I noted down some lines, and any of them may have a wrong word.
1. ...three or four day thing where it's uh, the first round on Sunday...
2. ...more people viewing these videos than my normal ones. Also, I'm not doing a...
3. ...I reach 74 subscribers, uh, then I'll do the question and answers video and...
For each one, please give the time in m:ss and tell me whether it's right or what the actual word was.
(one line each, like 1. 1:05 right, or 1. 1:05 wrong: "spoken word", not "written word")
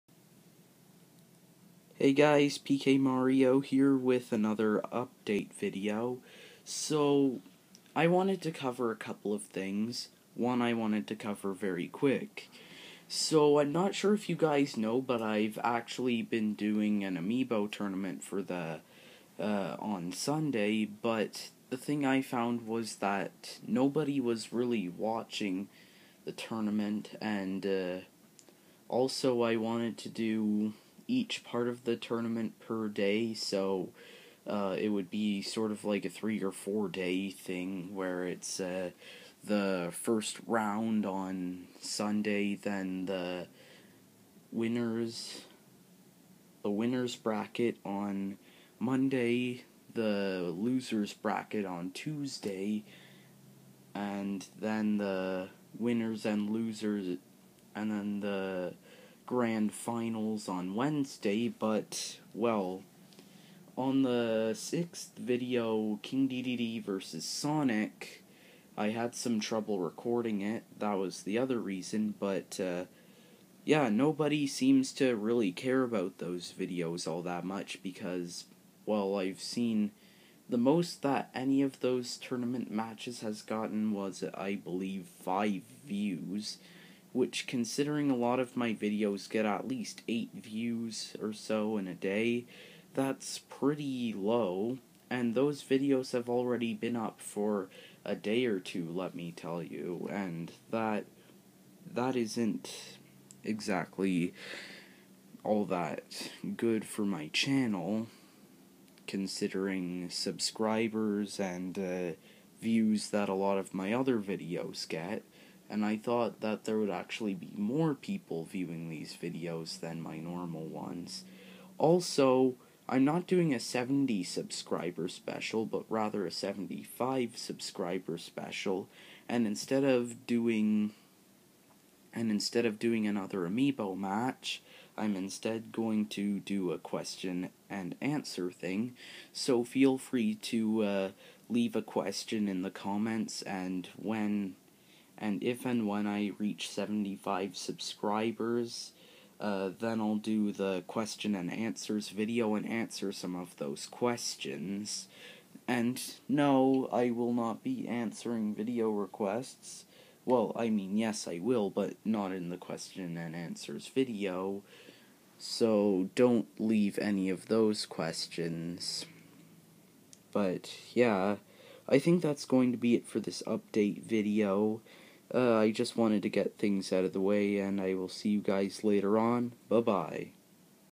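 1. 0:36 right
2. 1:57 right
3. 2:26 wrong: "75", not "74".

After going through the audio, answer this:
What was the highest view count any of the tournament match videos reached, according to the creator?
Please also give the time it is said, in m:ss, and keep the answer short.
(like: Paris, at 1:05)
5, at 1:25.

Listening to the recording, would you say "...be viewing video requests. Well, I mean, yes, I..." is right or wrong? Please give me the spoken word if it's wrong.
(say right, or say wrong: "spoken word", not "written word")
wrong: "answering", not "viewing".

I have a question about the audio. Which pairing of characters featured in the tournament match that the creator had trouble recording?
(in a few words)
King DDD versus Sonic.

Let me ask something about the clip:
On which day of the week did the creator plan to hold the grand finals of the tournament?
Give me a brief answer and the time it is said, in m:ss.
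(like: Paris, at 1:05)
Wednesday, at 1:00.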